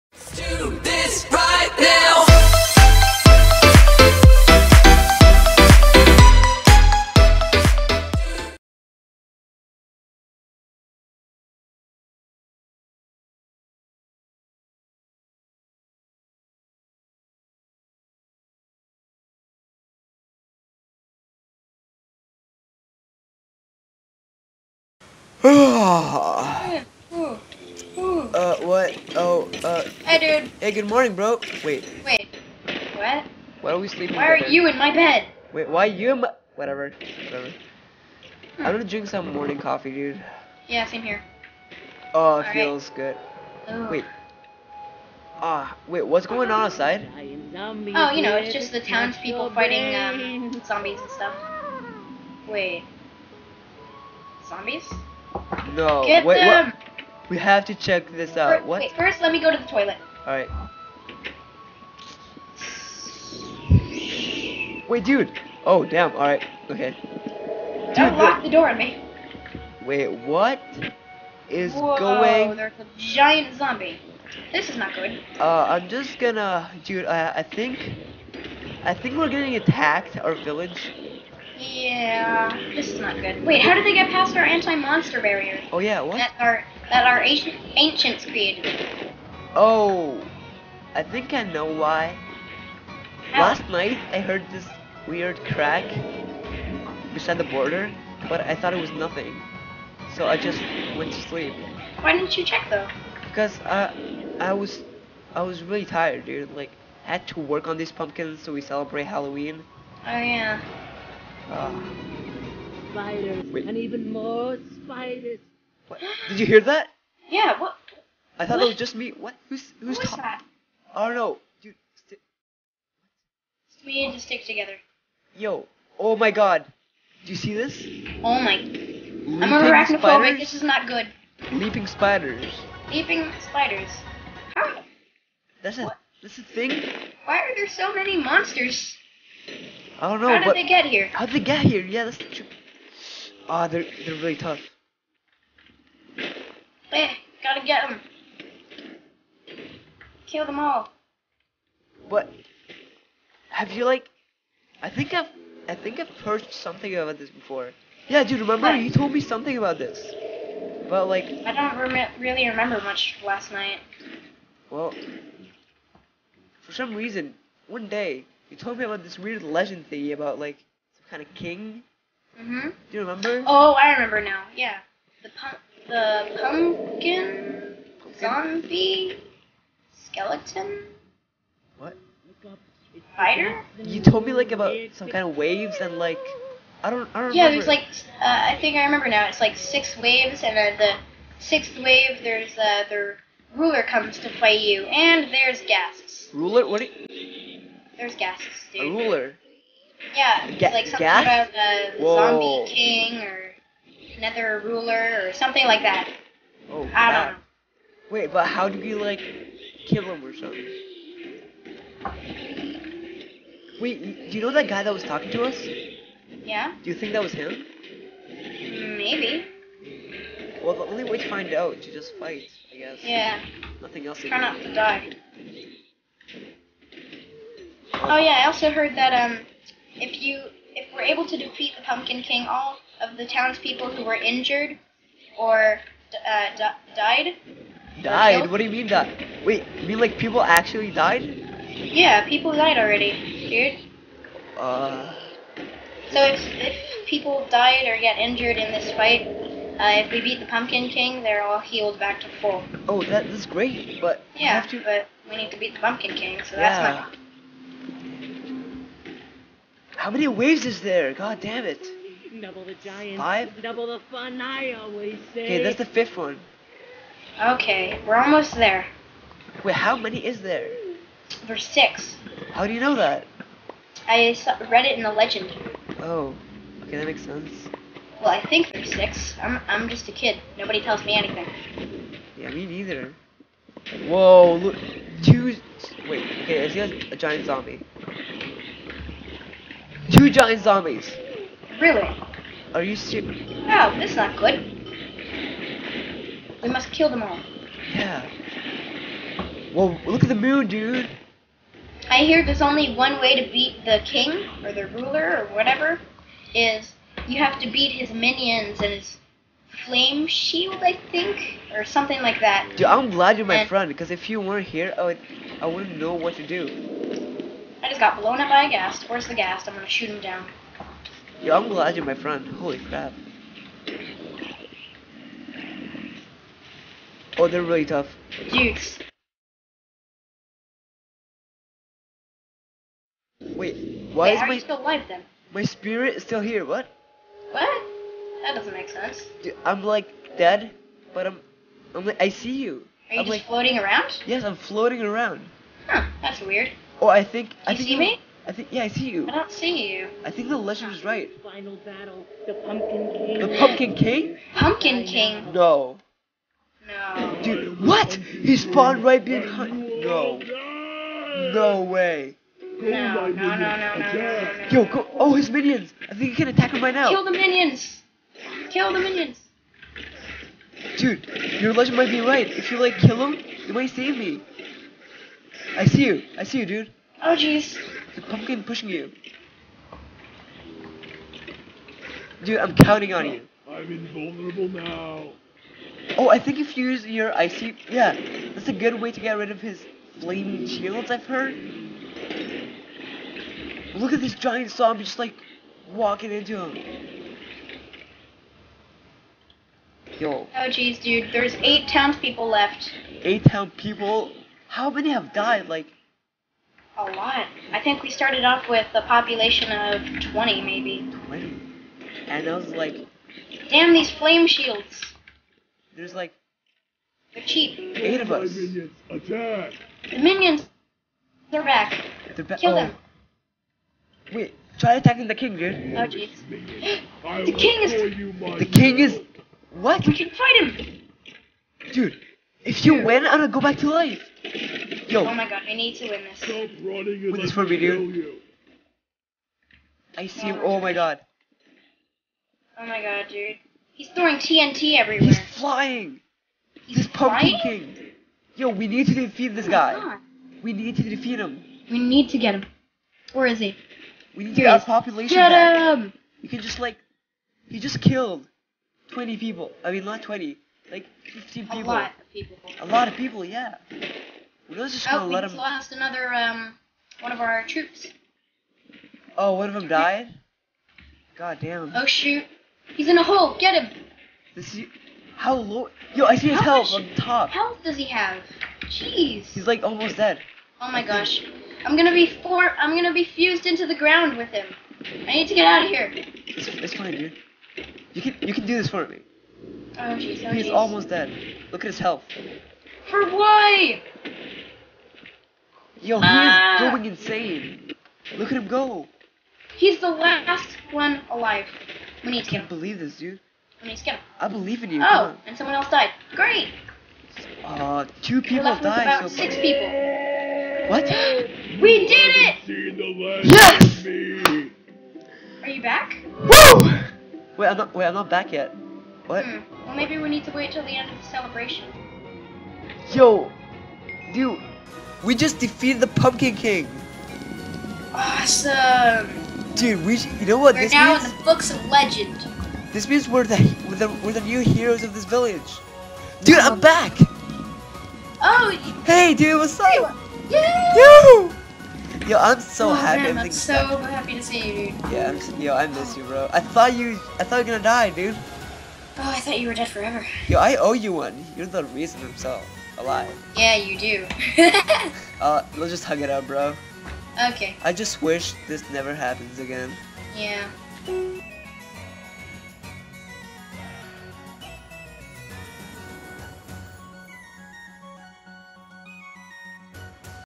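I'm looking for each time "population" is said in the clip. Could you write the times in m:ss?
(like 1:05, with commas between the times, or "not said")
6:49, 7:34.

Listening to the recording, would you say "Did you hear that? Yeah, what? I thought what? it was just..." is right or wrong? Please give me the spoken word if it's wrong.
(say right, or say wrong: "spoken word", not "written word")
right.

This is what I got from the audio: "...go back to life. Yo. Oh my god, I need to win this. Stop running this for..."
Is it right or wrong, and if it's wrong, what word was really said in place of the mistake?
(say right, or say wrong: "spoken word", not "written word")
right.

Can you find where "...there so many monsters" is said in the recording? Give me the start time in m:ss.
2:17.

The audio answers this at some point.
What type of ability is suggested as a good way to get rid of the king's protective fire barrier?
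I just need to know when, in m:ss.
6:27.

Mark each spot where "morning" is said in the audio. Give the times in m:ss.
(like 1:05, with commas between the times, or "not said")
0:30, 0:39.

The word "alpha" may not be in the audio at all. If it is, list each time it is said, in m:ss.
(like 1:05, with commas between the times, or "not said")
not said.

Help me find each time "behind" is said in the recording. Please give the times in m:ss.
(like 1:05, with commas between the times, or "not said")
5:59.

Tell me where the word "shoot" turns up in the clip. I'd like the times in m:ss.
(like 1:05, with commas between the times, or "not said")
5:19, 7:52.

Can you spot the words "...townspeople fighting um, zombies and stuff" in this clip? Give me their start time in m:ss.
0:48.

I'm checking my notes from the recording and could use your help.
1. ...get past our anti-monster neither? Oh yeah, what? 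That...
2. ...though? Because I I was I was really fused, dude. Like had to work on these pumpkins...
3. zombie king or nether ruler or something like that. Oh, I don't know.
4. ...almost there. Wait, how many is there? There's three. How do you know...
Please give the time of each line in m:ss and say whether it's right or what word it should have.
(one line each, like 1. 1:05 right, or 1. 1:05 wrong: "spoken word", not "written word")
1. 1:23 wrong: "barrier", not "neither"
2. 1:42 wrong: "tired", not "fused"
3. 3:22 right
4. 4:28 wrong: "six", not "three".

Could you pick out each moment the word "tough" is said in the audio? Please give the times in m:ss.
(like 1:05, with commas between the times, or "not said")
2:24, 5:27.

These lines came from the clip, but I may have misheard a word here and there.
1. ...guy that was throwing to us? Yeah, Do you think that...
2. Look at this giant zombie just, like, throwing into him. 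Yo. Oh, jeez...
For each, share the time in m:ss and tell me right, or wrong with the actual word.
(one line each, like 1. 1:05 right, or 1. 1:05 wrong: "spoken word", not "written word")
1. 3:34 wrong: "talking", not "throwing"
2. 6:33 wrong: "walking", not "throwing".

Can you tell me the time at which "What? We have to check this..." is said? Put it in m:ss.
0:56.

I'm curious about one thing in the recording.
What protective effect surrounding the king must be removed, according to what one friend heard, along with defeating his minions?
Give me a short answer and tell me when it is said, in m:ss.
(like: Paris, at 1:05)
Flame shield, at 5:09.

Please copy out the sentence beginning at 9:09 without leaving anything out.
Oh, I thought you were dead forever.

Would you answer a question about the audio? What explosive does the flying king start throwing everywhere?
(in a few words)
TNT.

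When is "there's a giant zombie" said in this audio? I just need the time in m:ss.
1:12.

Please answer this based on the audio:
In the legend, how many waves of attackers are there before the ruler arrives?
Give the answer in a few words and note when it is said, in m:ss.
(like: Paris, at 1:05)
6, at 3:09.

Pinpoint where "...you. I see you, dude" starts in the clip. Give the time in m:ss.
6:16.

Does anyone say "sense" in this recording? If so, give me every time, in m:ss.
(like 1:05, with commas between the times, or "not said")
4:37, 5:38.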